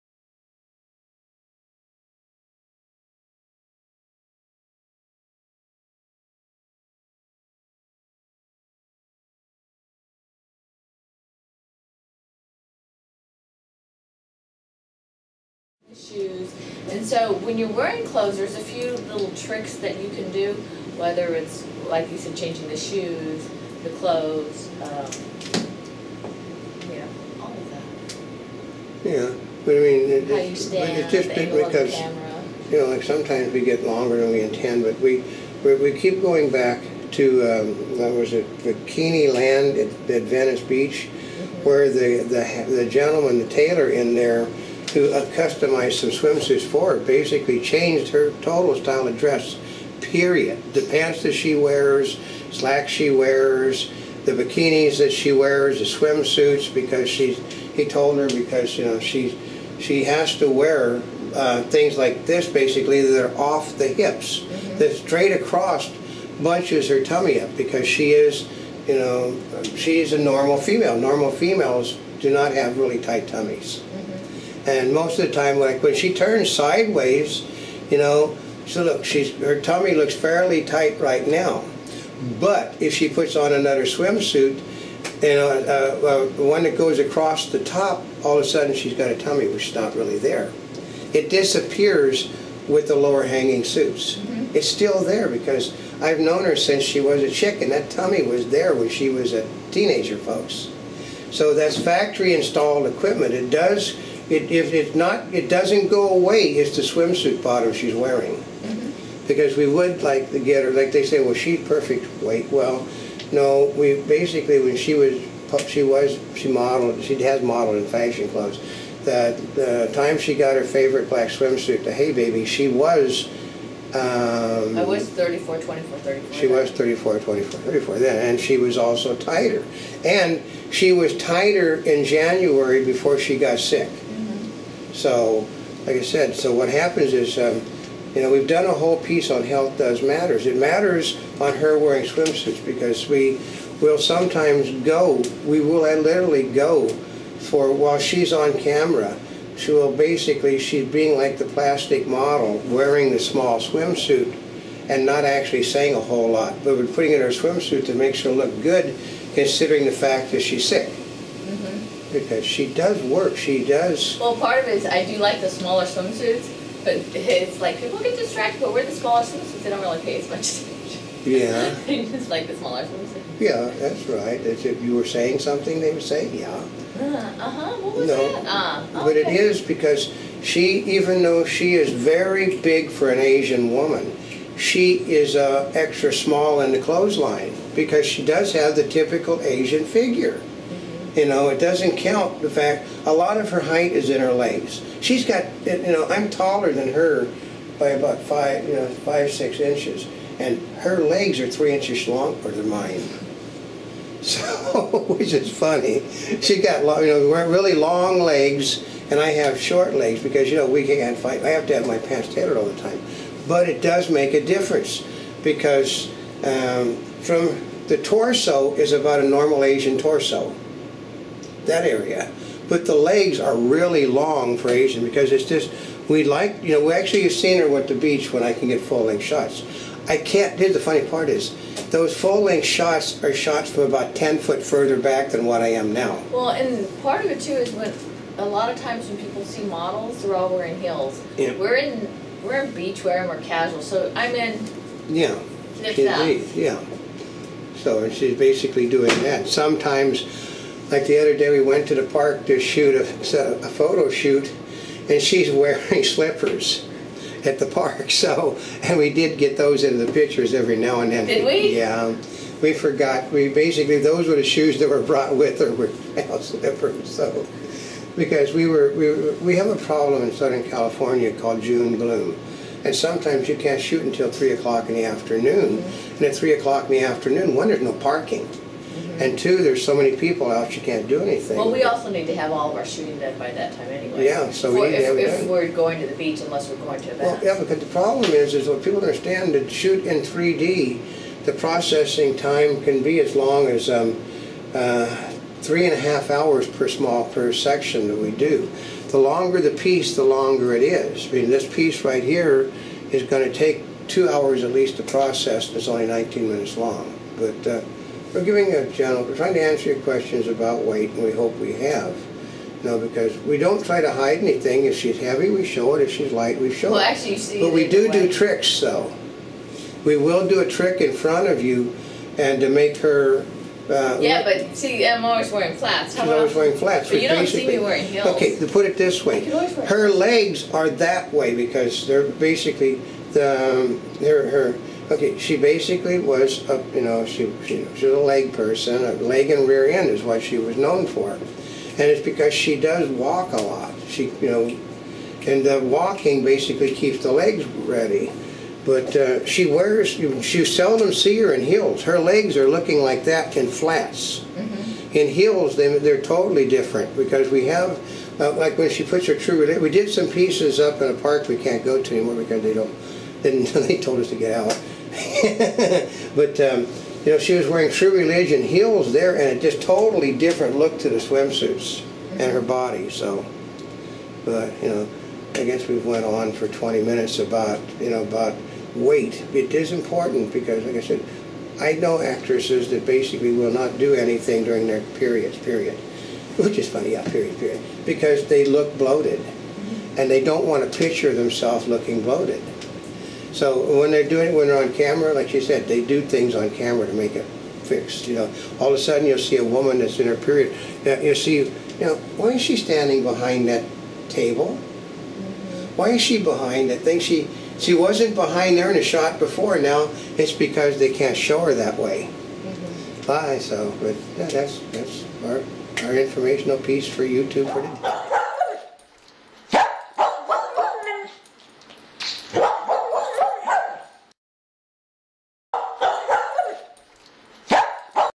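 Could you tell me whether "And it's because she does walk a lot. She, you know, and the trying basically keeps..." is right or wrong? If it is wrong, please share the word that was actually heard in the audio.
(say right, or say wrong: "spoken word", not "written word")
wrong: "walking", not "trying".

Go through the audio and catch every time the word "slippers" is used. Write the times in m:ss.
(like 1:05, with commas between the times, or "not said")
4:16, 4:26.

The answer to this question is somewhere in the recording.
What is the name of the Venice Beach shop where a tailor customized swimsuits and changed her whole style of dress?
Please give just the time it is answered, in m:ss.
0:38.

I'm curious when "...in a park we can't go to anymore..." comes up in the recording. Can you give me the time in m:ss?
6:01.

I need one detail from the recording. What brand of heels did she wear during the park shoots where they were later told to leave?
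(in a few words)
True Religion.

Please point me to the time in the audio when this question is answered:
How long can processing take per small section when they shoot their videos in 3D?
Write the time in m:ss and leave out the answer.
4:55.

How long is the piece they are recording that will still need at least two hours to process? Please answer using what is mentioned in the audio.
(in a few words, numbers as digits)
19 minutes.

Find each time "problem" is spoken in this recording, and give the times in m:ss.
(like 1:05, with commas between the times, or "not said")
4:29, 4:47.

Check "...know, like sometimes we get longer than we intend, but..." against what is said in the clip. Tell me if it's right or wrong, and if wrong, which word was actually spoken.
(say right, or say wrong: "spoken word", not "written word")
right.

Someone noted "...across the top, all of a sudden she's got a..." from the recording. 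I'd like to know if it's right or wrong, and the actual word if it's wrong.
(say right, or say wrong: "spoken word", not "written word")
right.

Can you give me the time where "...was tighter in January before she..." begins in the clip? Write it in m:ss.
2:10.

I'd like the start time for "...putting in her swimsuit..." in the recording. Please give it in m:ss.
2:36.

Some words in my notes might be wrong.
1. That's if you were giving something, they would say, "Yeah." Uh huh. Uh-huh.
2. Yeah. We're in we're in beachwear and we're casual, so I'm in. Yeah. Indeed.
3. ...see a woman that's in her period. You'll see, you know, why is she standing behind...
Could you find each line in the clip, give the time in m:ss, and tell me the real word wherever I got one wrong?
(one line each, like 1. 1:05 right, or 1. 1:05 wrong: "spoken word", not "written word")
1. 2:54 wrong: "saying", not "giving"
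2. 4:01 right
3. 6:39 right.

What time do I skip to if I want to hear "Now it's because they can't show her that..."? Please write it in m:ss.
6:49.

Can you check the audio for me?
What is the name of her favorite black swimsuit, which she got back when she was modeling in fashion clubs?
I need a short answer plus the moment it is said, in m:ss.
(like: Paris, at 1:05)
Hey Baby, at 2:01.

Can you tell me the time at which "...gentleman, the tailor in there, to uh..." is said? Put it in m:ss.
0:42.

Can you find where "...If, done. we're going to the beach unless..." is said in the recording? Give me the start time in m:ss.
4:45.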